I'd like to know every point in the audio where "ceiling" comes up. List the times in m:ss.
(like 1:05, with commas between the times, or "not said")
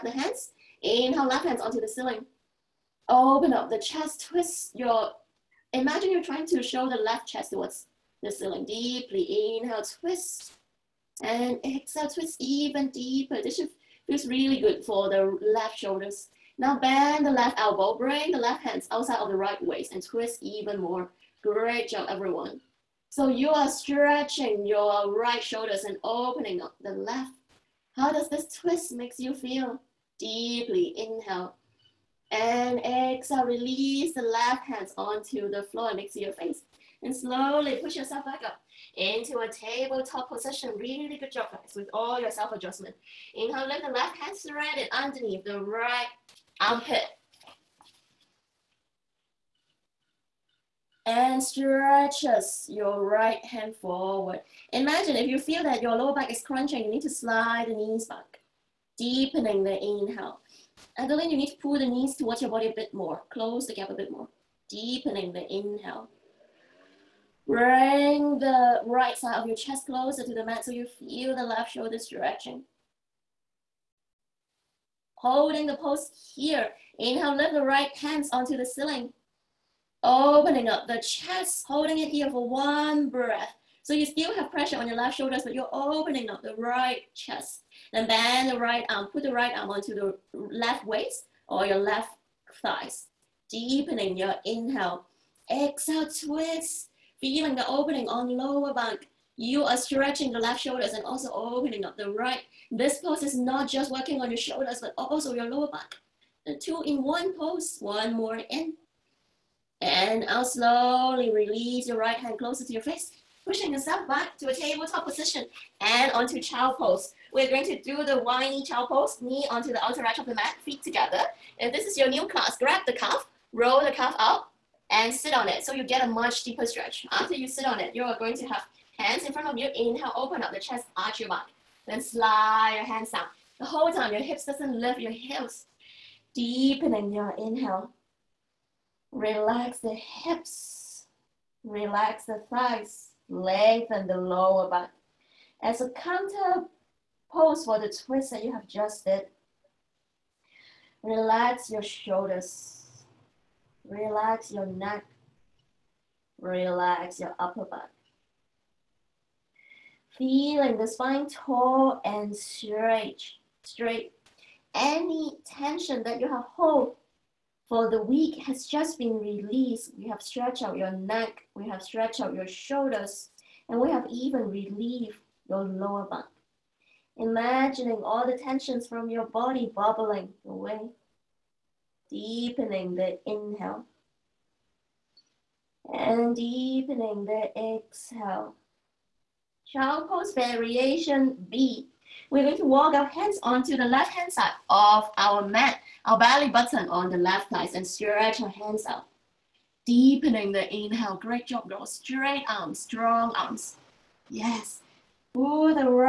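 0:01, 0:08, 1:18.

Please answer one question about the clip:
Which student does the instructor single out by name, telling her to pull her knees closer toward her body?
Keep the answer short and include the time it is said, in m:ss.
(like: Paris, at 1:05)
Adeline, at 1:00.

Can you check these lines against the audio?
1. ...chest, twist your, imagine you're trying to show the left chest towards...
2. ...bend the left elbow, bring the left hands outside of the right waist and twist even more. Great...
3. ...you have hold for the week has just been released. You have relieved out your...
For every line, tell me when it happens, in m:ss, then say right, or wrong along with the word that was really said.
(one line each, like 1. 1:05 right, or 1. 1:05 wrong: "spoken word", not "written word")
1. 0:03 right
2. 0:16 right
3. 2:46 wrong: "stretched", not "relieved".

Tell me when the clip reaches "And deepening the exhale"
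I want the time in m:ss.
3:05.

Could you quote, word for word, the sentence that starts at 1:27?
Then bend the right arm, put the right arm onto the left waist or your left thighs.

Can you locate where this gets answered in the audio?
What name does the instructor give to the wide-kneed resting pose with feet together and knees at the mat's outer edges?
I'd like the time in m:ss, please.
1:58.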